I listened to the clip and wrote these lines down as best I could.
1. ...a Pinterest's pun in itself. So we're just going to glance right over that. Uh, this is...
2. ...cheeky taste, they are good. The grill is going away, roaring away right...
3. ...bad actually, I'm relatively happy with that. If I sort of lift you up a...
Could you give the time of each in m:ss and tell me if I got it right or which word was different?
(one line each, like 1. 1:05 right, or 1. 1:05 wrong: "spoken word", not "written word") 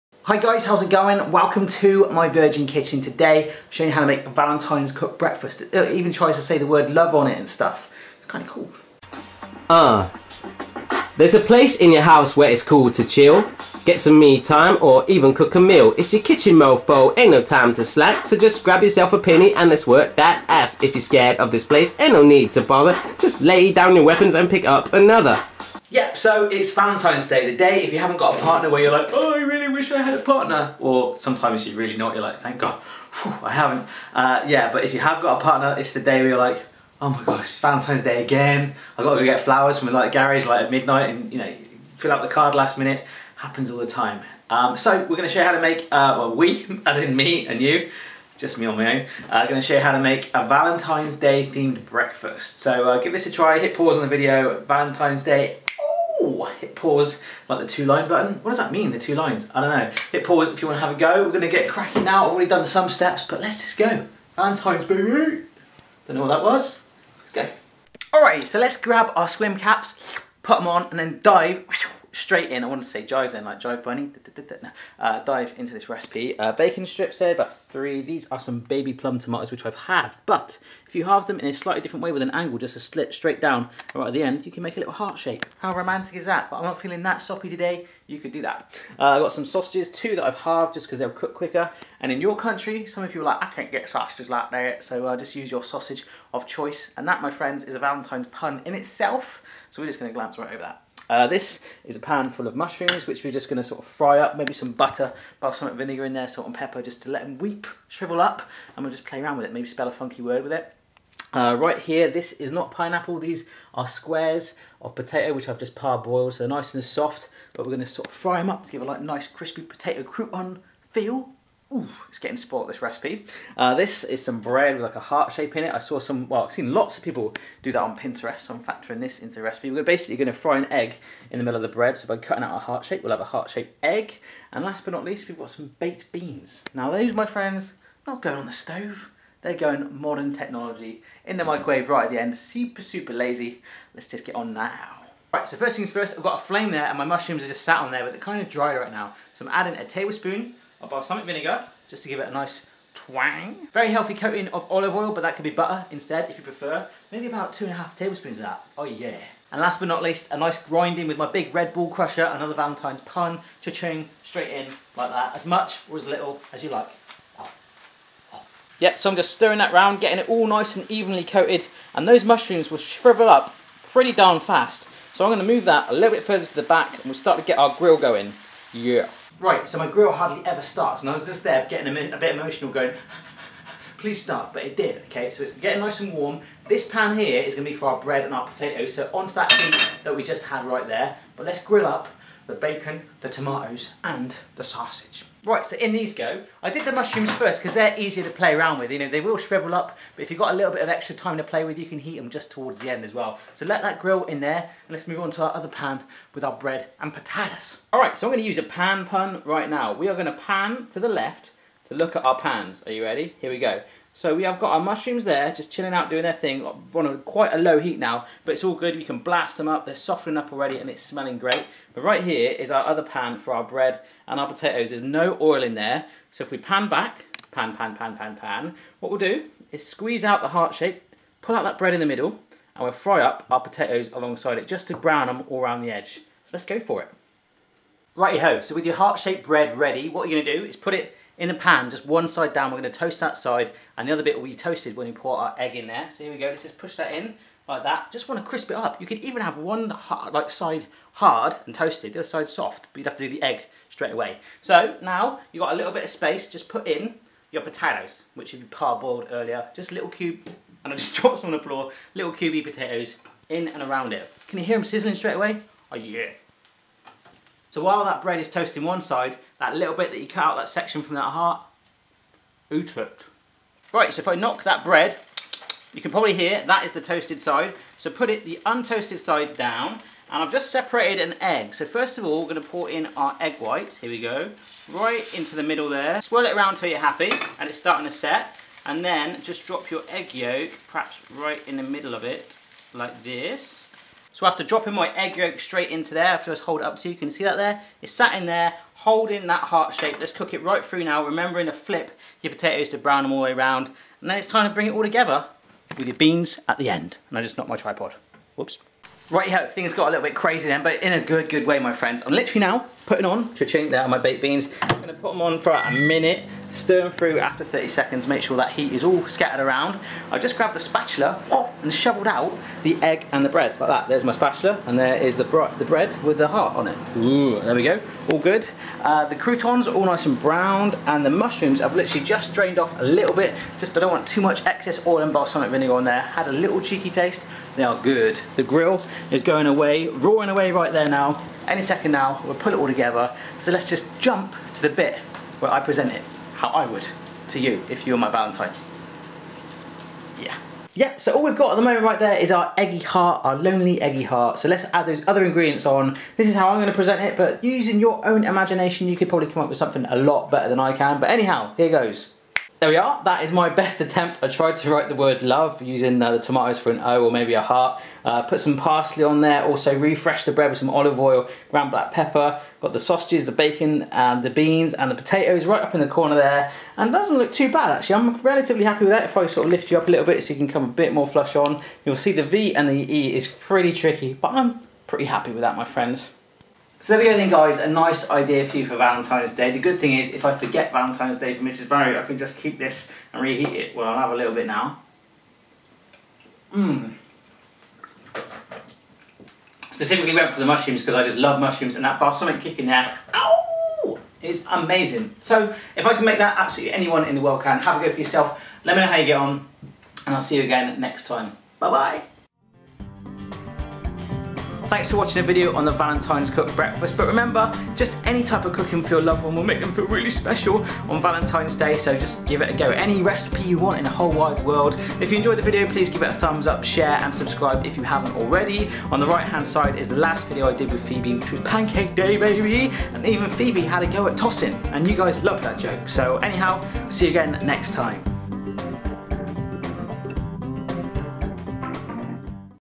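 1. 1:37 wrong: "Valentine", not "Pinterest"
2. 5:36 right
3. 6:17 right.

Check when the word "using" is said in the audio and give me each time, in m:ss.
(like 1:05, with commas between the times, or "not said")
5:57, 6:05.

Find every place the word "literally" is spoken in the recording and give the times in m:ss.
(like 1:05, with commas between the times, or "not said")
5:12, 5:31.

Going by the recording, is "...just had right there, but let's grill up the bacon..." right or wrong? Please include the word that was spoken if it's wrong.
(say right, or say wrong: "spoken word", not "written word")
right.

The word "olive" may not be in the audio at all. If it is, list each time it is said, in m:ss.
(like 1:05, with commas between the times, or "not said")
2:34, 6:10.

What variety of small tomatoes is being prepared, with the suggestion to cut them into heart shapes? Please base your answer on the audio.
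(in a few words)
Baby plum tomatoes.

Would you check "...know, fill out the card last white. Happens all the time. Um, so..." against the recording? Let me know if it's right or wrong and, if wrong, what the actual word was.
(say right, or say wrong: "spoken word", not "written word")
wrong: "minute", not "white".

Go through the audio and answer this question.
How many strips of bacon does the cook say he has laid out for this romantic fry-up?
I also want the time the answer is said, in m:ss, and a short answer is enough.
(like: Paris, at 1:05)
3, at 1:17.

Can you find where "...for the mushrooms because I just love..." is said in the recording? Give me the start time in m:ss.
6:40.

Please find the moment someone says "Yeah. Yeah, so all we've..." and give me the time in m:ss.
5:50.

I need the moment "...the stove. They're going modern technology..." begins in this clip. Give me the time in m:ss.
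2:18.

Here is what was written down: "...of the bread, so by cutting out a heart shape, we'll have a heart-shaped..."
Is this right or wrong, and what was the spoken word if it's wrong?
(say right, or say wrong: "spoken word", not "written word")
right.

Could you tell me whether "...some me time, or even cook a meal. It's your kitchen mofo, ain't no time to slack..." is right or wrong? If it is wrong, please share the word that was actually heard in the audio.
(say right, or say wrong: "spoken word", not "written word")
right.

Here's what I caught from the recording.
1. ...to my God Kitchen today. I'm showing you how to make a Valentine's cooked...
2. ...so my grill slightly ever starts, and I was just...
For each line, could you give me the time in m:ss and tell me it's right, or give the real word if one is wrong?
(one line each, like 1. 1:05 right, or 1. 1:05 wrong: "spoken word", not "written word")
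1. 0:01 wrong: "Virgin", not "God"
2. 2:59 wrong: "hardly", not "slightly".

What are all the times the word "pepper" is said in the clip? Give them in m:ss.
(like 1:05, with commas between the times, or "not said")
1:46, 6:12.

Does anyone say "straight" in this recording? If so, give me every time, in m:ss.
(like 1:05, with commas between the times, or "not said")
1:12, 1:23, 2:44, 4:13, 4:25, 4:55.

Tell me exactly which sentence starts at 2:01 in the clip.
Ooh, it's getting spoilt, this recipe.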